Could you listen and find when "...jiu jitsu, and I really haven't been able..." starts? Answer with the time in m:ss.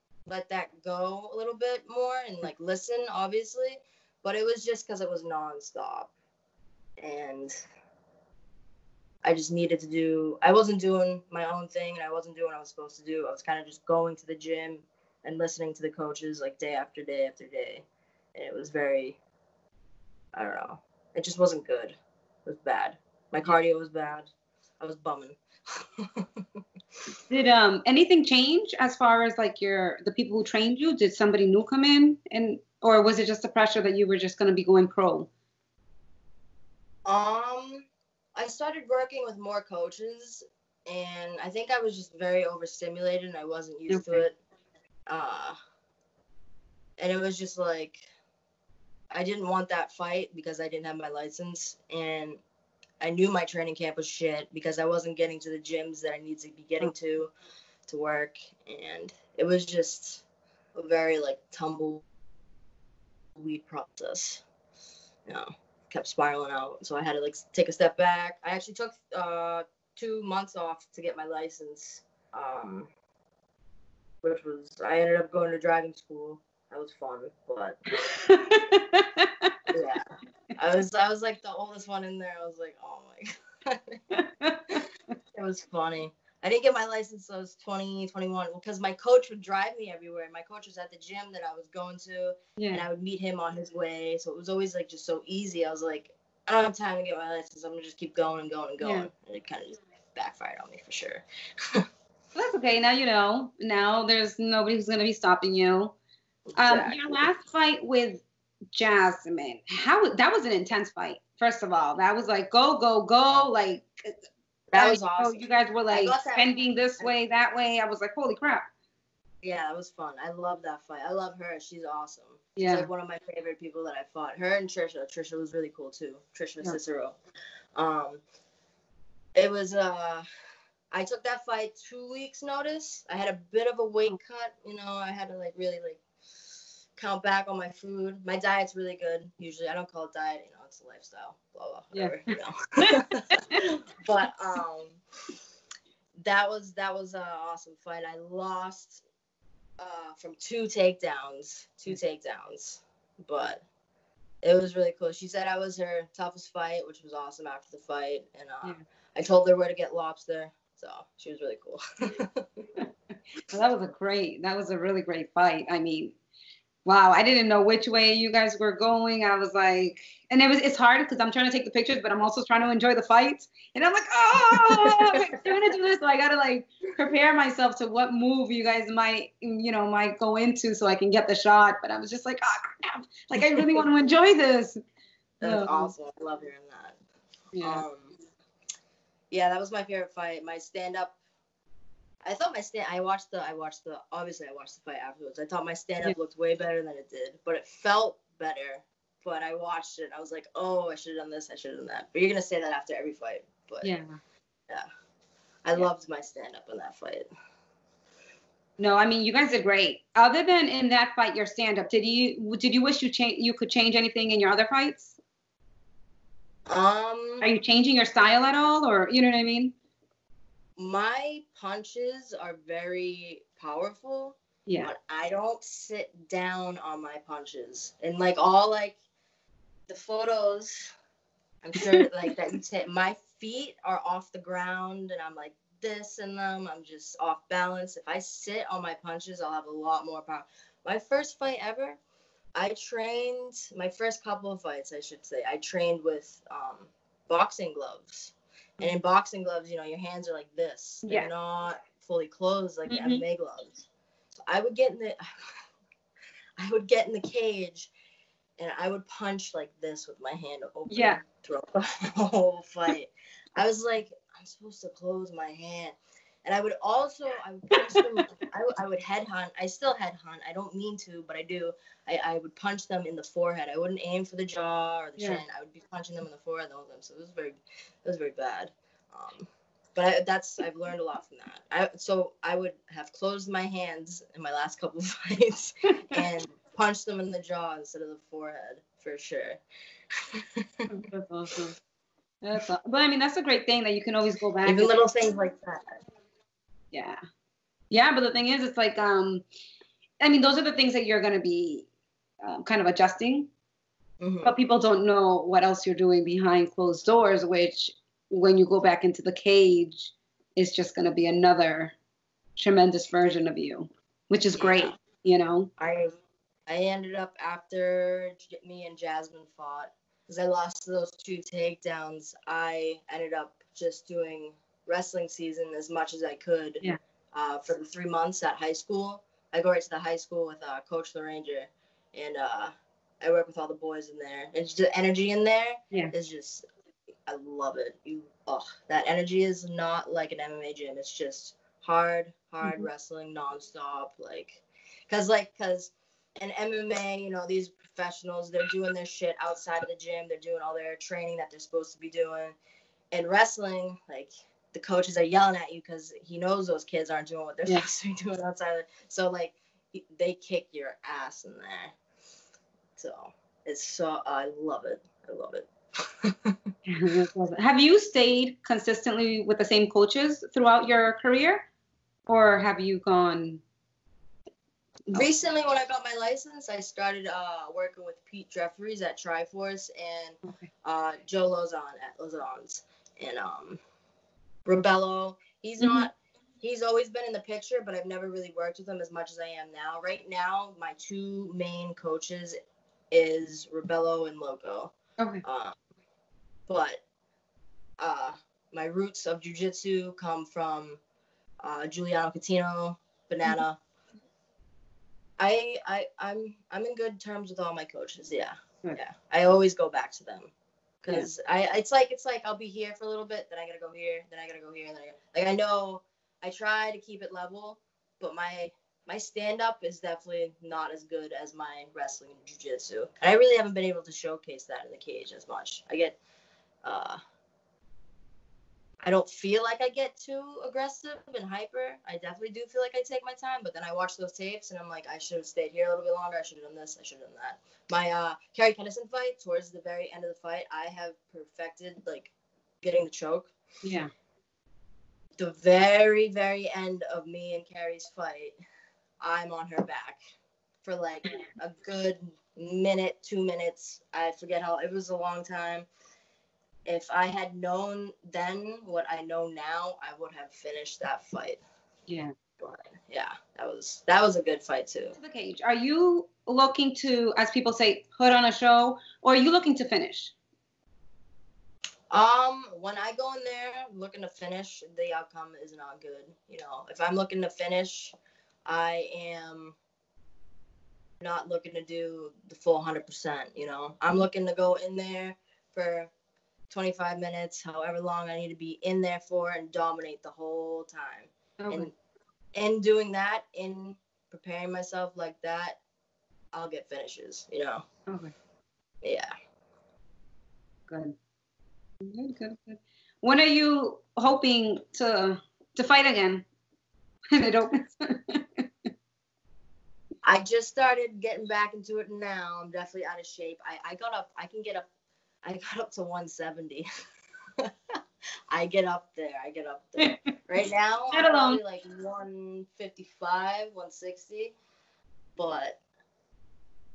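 7:02.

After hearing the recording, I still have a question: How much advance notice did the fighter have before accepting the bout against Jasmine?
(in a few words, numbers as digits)
2 weeks.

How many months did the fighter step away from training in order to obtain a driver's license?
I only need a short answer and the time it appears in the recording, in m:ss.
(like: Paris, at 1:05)
2, at 1:09.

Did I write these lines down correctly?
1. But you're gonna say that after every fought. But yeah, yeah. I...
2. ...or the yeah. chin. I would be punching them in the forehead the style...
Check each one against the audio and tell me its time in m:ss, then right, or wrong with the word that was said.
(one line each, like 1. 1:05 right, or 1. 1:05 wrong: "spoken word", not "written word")
1. 3:22 wrong: "fight", not "fought"
2. 4:35 wrong: "whole", not "style".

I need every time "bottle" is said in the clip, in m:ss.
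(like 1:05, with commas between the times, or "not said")
not said.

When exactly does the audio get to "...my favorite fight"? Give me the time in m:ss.
3:09.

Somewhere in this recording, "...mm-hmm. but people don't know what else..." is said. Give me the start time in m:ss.
5:04.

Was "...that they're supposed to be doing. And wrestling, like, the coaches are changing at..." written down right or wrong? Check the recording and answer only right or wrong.
wrong.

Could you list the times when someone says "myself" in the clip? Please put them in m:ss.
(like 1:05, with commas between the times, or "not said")
2:57, 8:14.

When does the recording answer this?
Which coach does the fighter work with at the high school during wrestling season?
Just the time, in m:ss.
5:30.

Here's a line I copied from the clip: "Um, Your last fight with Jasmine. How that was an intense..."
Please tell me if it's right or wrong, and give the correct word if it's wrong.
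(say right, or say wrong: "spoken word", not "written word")
right.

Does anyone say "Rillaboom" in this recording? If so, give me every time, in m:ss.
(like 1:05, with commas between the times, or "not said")
not said.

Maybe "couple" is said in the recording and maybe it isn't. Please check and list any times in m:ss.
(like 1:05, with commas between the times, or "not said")
4:04, 4:44.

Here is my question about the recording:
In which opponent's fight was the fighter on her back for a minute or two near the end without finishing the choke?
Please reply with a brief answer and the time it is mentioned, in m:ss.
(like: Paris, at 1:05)
Carrie Kennison, at 7:18.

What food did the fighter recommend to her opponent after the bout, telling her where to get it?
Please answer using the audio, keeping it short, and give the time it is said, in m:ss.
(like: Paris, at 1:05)
Lobster, at 2:39.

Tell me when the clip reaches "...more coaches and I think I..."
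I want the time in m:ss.
0:39.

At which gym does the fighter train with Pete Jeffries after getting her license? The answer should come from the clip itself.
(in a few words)
Triforce.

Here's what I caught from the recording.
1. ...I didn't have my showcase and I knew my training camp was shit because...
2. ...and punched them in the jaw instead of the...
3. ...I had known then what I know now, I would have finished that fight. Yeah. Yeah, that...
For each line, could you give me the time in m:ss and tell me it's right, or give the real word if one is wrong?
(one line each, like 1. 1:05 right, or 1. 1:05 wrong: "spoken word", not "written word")
1. 0:50 wrong: "license", not "showcase"
2. 4:46 right
3. 7:37 right.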